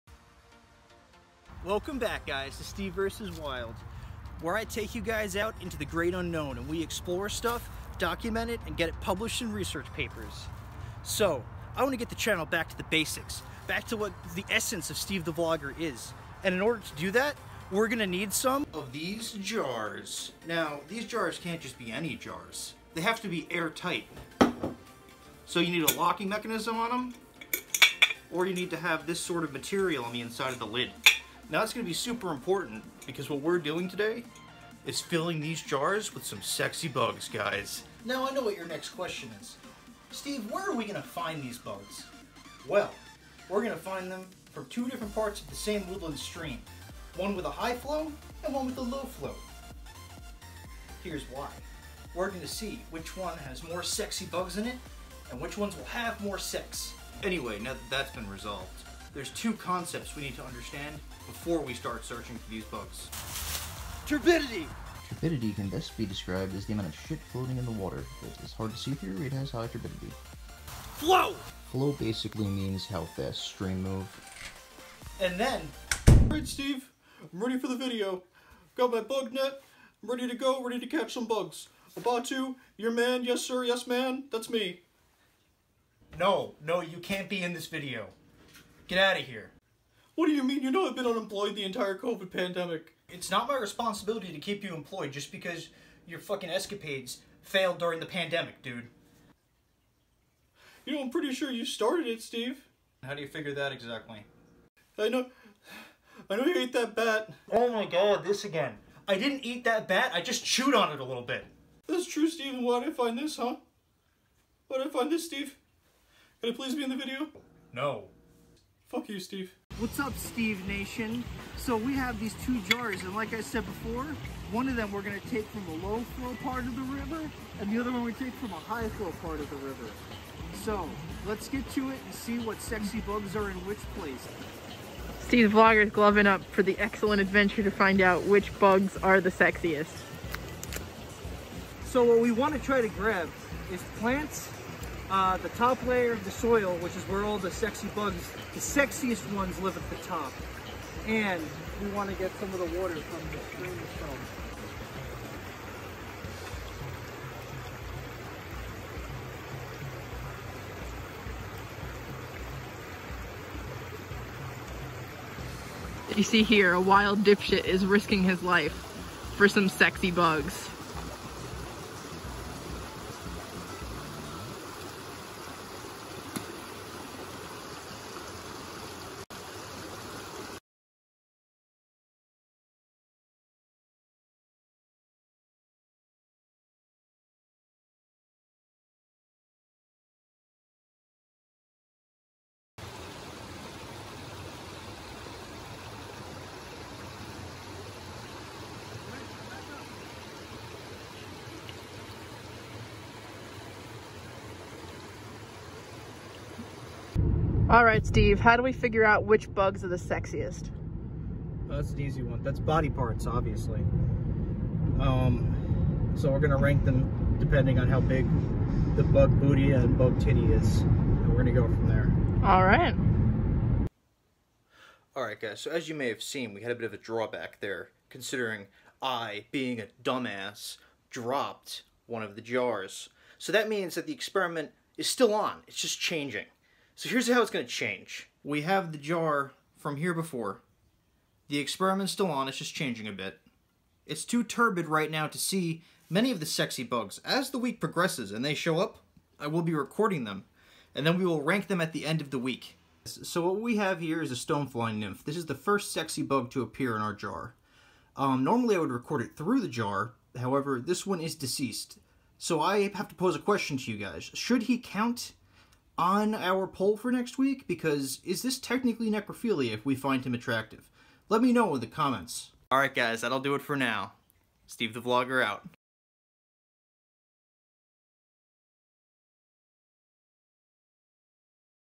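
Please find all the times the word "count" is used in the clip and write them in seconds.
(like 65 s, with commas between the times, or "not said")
264 s.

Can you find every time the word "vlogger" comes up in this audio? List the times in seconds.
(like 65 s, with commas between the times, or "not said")
15 s, 135 s, 275 s.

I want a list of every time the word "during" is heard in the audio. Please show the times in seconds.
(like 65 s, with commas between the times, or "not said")
97 s.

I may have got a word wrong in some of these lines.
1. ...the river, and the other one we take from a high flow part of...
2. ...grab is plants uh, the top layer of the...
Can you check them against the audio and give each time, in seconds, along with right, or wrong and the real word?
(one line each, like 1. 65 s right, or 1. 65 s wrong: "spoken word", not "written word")
1. 126 s right
2. 142 s right.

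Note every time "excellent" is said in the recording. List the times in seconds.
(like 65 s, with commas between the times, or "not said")
136 s.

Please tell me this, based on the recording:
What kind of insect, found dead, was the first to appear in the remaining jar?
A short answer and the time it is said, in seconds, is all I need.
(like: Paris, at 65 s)
Stonefly nymph, at 254 s.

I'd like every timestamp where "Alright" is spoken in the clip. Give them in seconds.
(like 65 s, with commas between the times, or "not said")
76 s, 272 s.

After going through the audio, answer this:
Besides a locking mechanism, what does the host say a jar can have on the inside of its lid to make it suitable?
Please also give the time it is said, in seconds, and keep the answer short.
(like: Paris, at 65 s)
this sort of material, at 29 s.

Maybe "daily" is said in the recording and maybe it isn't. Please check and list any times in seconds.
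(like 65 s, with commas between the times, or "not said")
not said.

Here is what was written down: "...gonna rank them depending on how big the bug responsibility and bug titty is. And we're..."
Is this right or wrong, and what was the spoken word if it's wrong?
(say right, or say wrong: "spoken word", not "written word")
wrong: "booty", not "responsibility".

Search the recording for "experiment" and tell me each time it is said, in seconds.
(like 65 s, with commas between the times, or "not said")
234 s, 241 s.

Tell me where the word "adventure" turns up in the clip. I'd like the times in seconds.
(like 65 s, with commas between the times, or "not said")
137 s.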